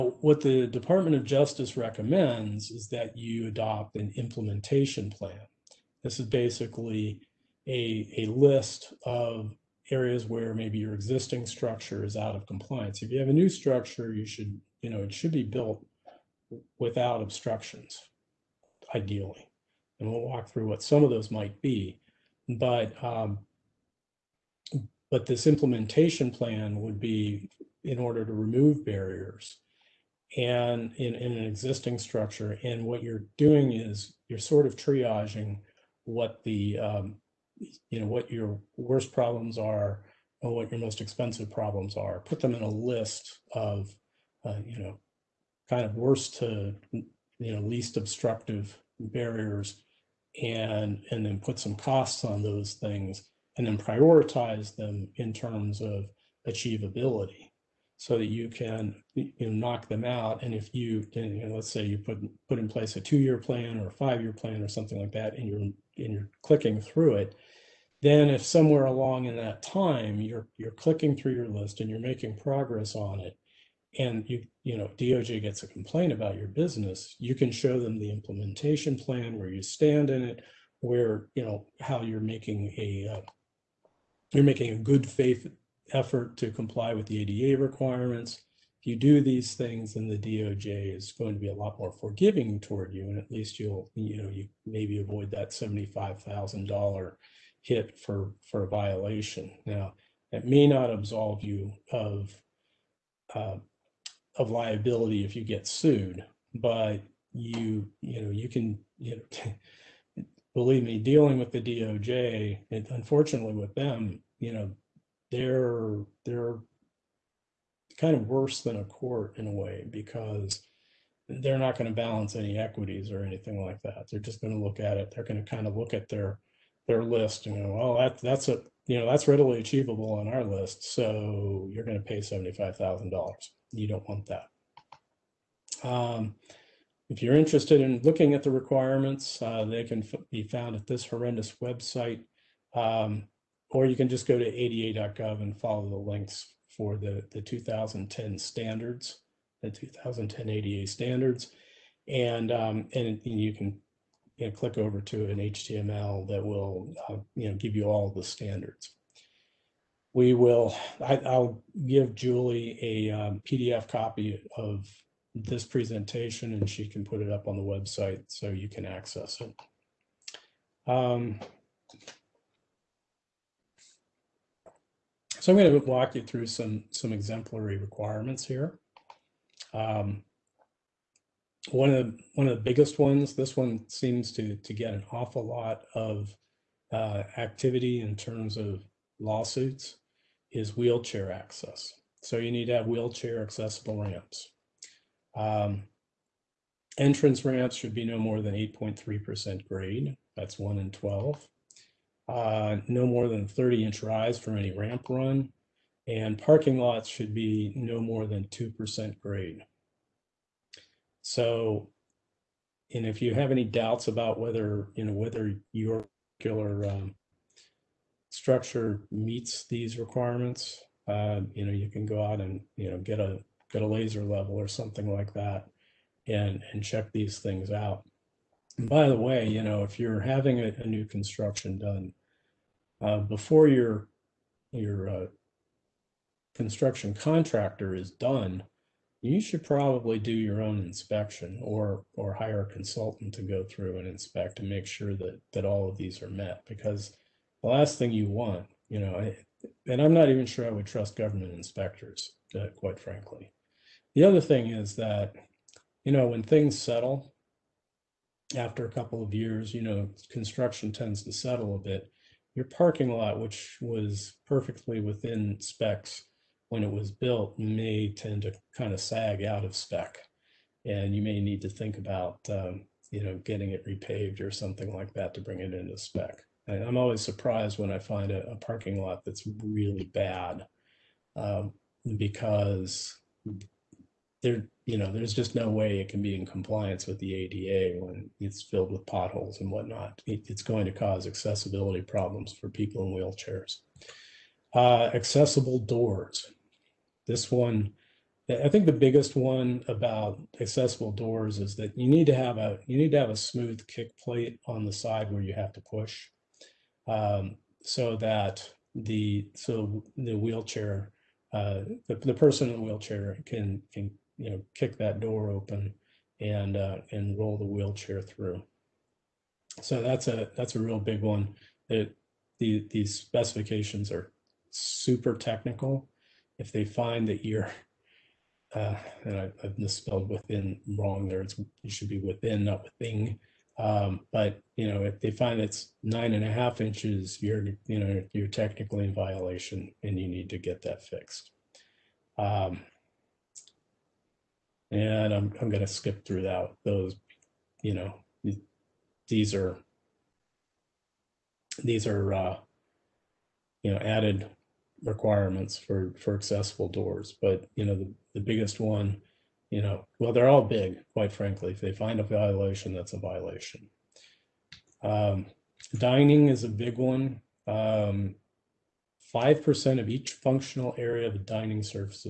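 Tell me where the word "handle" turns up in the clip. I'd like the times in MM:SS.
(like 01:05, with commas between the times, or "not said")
not said.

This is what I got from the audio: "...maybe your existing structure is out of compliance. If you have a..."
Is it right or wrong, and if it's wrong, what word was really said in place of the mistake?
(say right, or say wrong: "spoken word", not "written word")
right.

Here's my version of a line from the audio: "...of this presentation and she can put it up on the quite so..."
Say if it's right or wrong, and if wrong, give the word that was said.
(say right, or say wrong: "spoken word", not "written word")
wrong: "website", not "quite".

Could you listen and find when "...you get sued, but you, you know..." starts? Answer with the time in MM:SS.
01:45.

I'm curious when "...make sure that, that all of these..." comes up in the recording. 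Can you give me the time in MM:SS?
04:04.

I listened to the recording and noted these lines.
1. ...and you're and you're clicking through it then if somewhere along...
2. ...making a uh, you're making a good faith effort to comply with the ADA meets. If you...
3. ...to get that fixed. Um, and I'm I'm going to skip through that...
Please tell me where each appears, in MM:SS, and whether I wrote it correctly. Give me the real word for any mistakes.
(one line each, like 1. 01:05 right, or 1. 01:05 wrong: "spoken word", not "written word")
1. 01:05 right
2. 01:22 wrong: "requirements", not "meets"
3. 05:40 right.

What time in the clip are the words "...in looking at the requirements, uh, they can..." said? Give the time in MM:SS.
02:17.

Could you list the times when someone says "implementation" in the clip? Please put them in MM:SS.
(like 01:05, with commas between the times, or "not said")
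00:04, 00:25, 01:18.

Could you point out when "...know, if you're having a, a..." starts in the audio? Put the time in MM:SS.
03:49.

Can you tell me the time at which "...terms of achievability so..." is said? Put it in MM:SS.
00:55.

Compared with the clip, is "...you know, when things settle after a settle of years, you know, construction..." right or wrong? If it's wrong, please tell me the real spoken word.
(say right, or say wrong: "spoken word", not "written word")
wrong: "couple", not "settle".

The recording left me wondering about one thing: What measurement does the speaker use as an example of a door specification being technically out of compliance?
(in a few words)
9.5 inches.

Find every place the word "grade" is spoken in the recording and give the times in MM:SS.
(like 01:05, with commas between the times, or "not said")
03:19, 03:29.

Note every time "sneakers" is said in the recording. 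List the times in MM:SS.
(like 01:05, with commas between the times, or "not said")
not said.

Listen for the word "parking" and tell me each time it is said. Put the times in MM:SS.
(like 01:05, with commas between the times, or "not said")
03:26, 04:22, 04:38.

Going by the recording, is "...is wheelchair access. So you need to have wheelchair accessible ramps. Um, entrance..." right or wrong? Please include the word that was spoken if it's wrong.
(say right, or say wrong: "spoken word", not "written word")
right.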